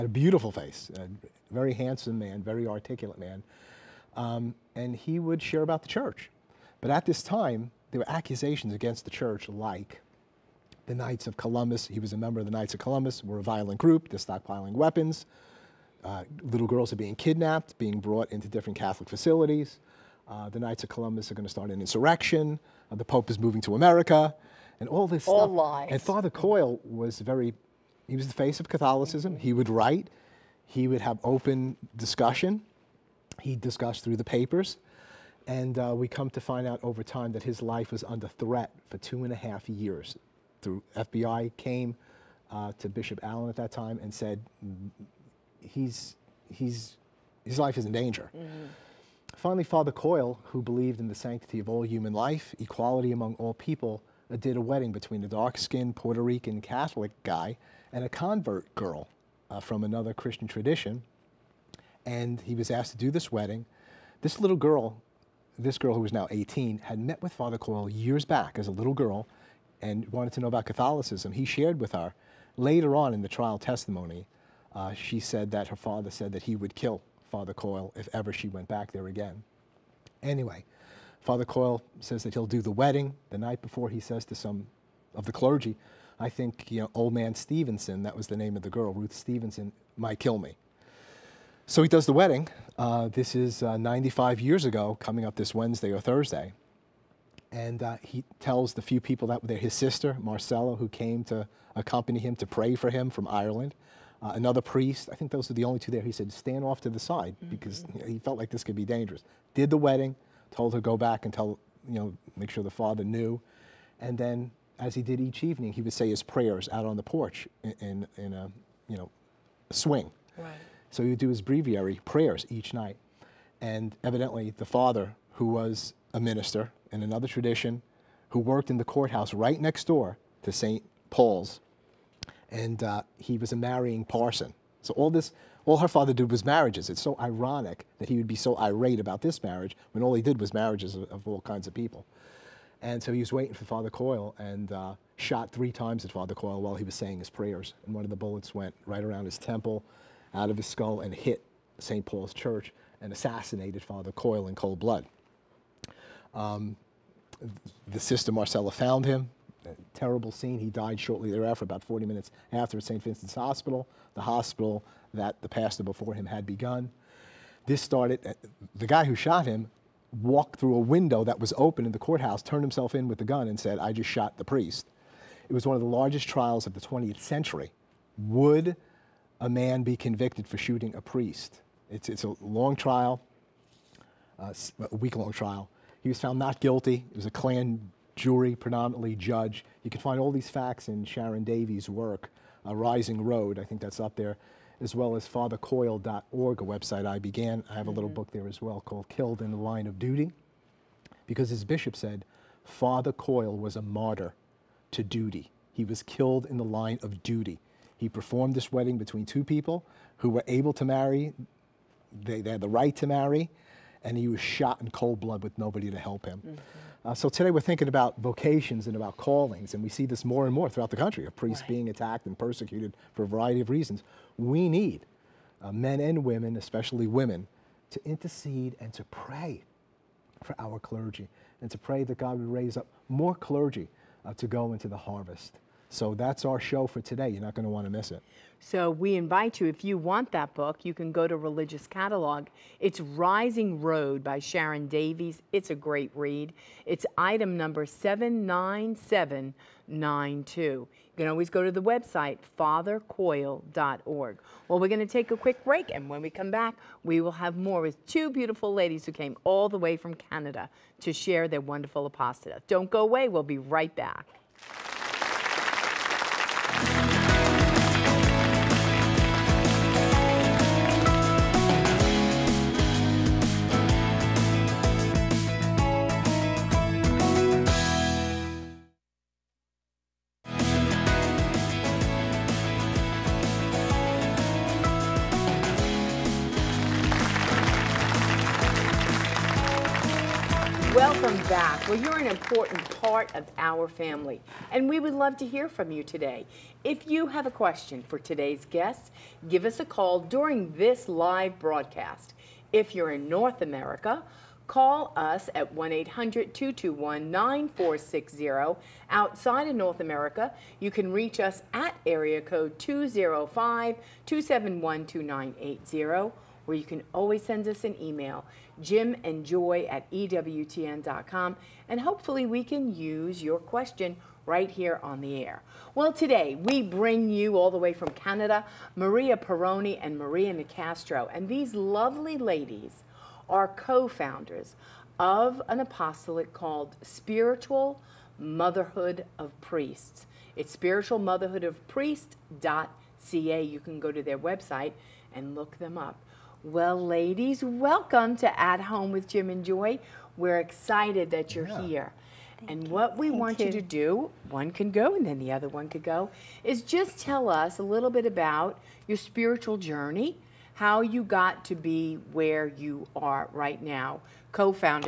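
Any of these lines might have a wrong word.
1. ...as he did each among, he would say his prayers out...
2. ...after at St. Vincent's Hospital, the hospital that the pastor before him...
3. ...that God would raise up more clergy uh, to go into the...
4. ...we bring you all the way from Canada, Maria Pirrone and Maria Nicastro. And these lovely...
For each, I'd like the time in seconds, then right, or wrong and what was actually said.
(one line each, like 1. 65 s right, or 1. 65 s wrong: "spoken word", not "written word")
1. 114 s wrong: "evening", not "among"
2. 162 s right
3. 232 s right
4. 326 s right.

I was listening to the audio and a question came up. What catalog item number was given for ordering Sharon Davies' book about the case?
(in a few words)
79792.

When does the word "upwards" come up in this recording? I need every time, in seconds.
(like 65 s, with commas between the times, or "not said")
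not said.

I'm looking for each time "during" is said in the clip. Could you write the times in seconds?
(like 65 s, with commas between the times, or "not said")
300 s.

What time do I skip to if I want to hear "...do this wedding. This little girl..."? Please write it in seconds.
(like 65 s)
63 s.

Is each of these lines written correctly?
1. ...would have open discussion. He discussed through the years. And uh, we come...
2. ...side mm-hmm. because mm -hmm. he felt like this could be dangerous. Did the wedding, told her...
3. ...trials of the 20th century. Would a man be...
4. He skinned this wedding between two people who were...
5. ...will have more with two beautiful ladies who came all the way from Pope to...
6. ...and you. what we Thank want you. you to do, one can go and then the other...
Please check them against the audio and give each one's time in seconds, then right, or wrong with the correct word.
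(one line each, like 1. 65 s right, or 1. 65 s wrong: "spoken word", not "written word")
1. 30 s wrong: "papers", not "years"
2. 106 s right
3. 176 s right
4. 207 s wrong: "performed", not "skinned"
5. 257 s wrong: "Canada", not "Pope"
6. 352 s right.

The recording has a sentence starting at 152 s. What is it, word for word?
Paul's Church and assassinated Father Coyle in cold blood.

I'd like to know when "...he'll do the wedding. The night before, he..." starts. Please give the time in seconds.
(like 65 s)
82 s.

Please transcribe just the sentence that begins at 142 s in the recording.
And so he was waiting for Father Coyle and uh, shot three times at Father Coyle while he was saying his prayers.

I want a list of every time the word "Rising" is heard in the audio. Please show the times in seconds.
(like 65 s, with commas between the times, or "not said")
192 s, 243 s.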